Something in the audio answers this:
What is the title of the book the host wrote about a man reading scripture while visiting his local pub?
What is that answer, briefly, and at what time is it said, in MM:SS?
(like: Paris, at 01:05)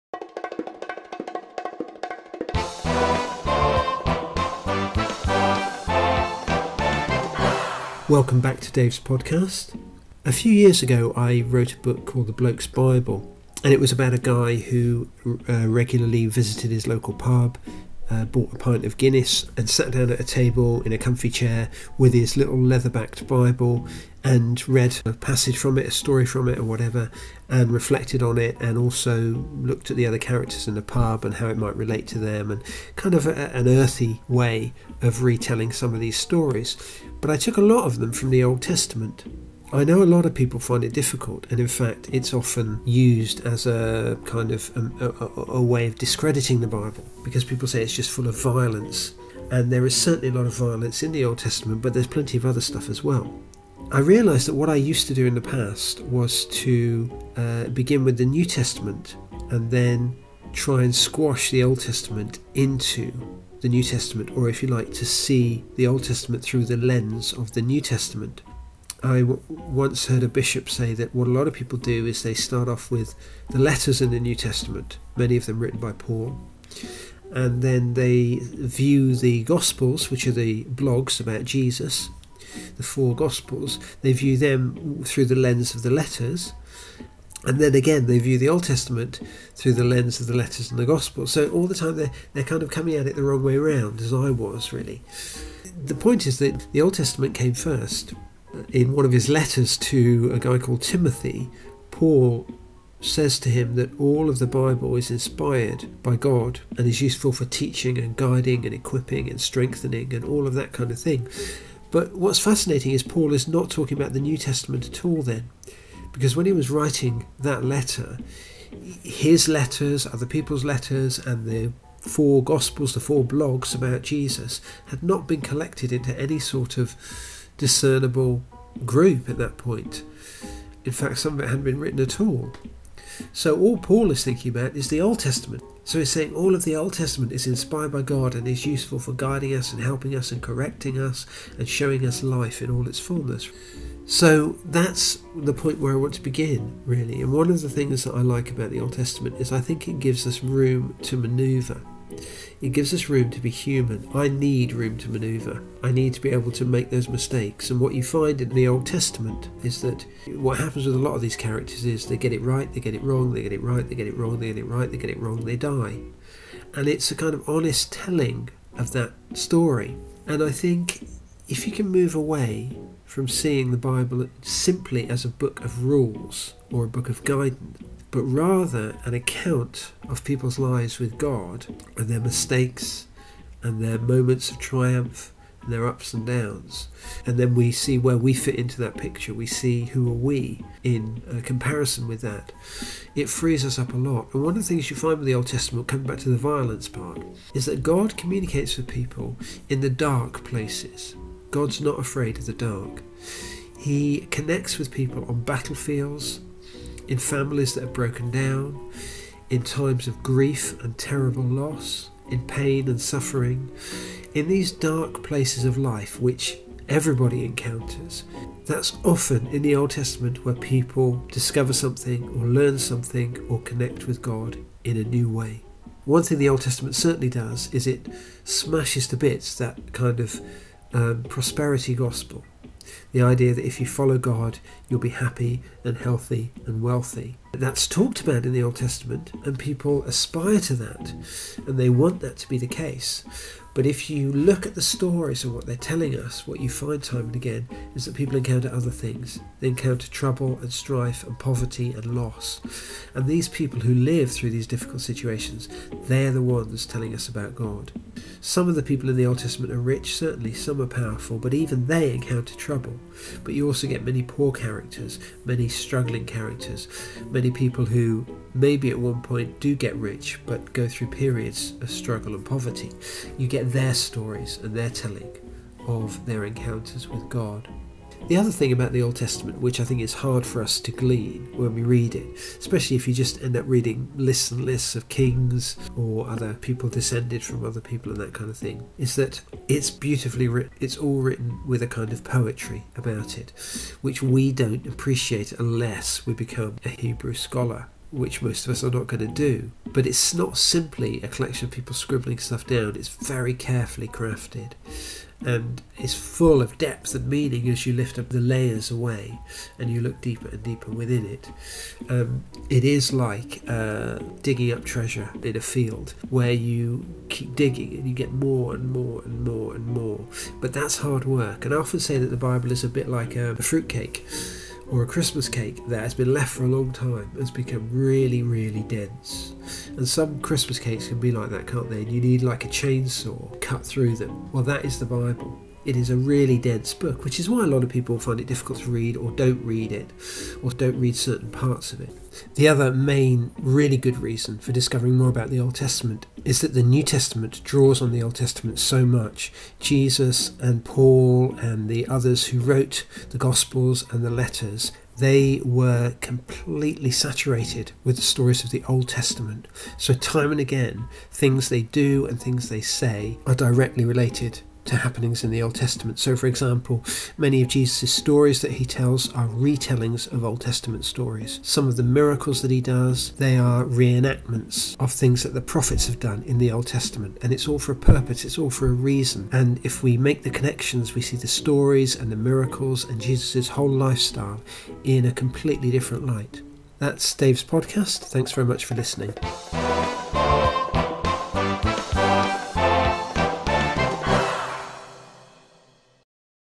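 The Bloke's Bible, at 00:12.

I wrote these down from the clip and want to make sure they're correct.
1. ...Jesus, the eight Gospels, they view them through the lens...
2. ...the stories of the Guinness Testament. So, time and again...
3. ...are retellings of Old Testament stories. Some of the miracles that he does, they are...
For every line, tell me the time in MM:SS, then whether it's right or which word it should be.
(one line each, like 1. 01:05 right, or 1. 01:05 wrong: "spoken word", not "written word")
1. 01:21 wrong: "four", not "eight"
2. 05:58 wrong: "Old", not "Guinness"
3. 06:09 right.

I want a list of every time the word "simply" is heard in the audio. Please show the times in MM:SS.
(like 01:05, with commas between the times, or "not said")
02:54, 05:00.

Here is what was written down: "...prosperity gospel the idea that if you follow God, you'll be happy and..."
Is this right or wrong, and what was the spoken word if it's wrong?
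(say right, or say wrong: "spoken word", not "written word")
right.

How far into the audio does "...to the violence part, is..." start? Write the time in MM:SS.
03:16.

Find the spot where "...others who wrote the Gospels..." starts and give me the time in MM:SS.
05:52.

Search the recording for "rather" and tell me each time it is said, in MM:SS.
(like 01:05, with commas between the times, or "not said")
02:58.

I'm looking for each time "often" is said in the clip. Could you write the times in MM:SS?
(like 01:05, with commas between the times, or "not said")
00:42, 03:39, 05:21.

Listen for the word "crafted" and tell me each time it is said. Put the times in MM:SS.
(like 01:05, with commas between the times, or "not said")
05:04.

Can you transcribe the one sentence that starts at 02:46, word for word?
And it's a kind of honest telling of that story.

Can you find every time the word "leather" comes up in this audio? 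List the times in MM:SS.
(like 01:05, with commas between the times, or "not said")
00:22.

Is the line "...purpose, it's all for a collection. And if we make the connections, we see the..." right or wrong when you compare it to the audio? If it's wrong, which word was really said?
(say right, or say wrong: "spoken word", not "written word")
wrong: "reason", not "collection".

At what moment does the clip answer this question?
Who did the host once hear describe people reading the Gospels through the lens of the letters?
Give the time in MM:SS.
01:10.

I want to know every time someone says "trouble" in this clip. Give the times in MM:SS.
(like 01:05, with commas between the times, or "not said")
04:10, 04:22.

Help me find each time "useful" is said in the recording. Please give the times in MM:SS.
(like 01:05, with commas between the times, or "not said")
01:47, 02:18.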